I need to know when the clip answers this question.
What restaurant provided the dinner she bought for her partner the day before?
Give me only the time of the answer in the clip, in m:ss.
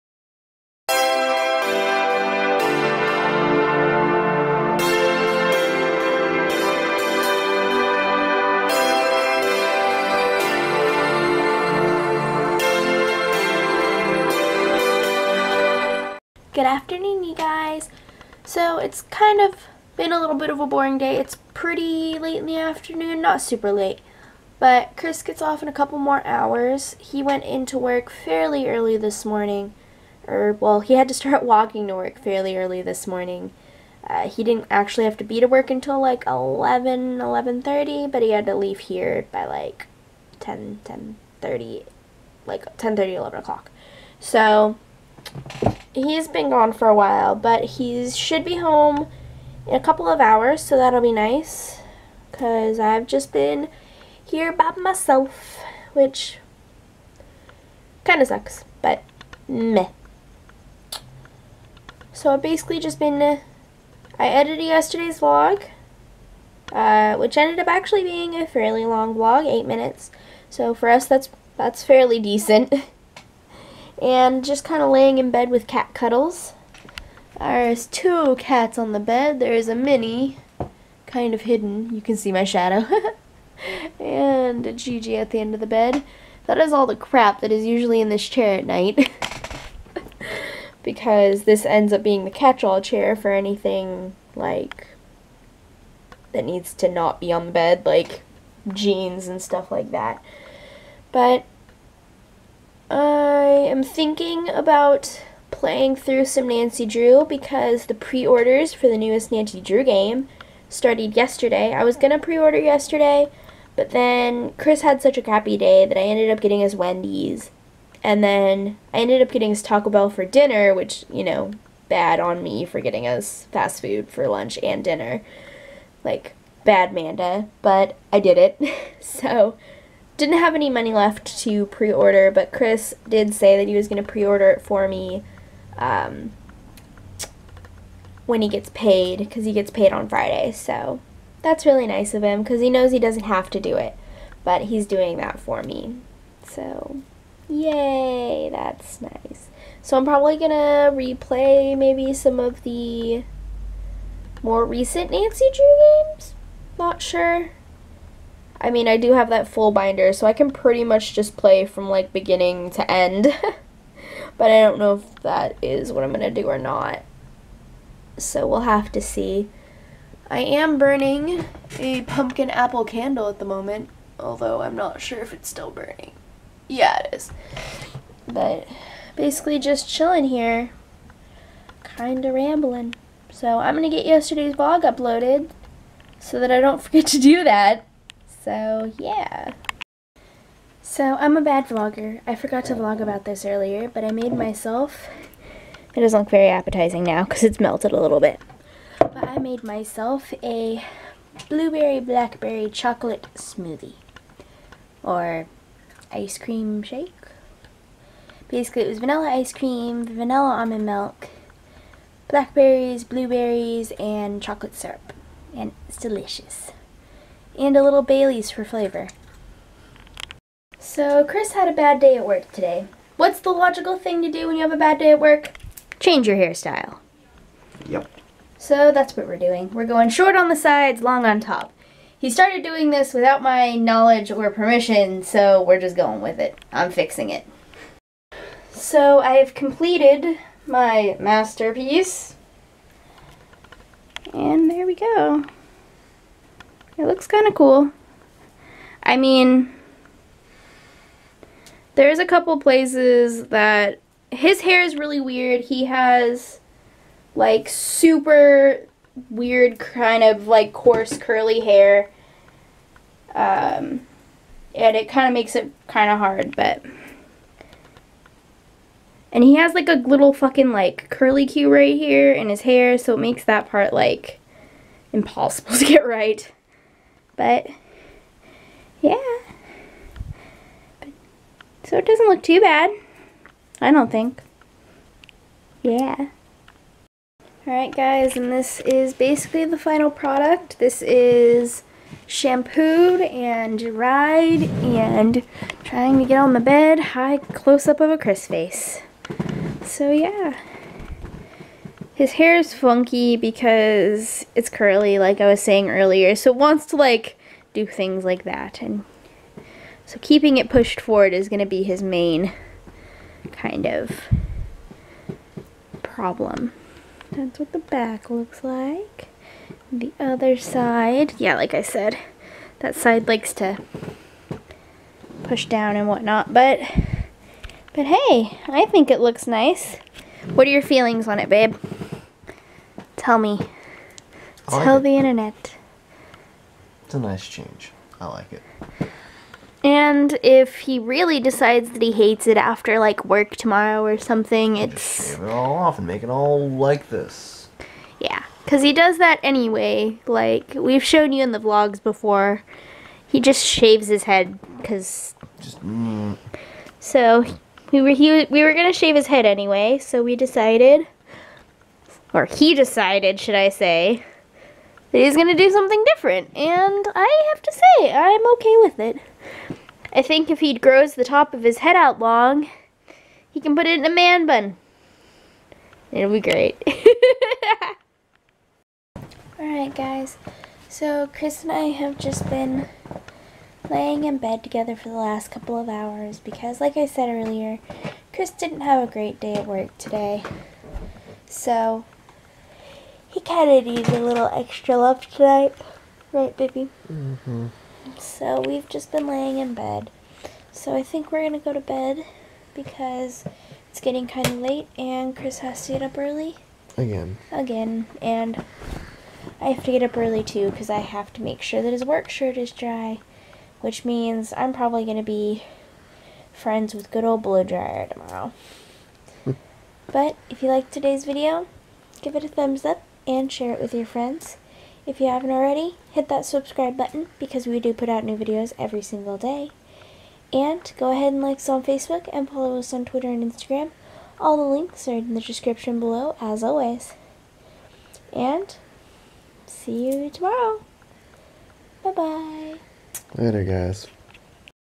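1:59.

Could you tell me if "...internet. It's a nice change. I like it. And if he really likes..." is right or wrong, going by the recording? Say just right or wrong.
wrong.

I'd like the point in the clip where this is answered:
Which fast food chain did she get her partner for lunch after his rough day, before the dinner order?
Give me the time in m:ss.
1:56.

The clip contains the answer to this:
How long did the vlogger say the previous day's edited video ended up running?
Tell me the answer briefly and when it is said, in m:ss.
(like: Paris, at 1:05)
8 minutes, at 1:09.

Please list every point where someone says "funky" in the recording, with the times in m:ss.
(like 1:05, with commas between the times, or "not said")
5:02.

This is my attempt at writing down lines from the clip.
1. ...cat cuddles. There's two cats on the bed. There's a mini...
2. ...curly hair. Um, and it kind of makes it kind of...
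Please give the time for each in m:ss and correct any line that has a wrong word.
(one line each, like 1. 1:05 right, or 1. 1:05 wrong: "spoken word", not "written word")
1. 1:15 right
2. 4:21 right.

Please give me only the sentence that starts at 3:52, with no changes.
He started doing this without my knowledge or permission, so we're just going with it.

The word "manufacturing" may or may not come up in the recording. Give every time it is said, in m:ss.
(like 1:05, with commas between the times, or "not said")
not said.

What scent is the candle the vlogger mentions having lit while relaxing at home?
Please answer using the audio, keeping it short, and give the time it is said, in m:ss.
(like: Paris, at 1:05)
pumpkin apple, at 2:52.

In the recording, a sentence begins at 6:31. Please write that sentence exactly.
So he kind of needs a little extra love tonight.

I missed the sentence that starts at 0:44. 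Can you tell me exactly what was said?
So, he's been gone for a while, but he should be home in a couple of hours, so that'll be nice.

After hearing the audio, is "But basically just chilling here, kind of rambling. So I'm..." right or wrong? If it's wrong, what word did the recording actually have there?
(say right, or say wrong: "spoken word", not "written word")
right.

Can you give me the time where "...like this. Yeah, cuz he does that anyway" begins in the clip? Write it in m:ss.
5:46.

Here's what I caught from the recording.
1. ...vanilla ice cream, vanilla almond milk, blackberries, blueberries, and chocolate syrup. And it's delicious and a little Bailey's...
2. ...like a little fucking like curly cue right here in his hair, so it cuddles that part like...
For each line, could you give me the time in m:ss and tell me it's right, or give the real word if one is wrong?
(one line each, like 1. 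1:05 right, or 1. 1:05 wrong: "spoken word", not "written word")
1. 3:28 right
2. 4:29 wrong: "makes", not "cuddles".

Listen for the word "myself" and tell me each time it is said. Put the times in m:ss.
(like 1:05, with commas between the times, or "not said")
0:54, 3:14, 3:19.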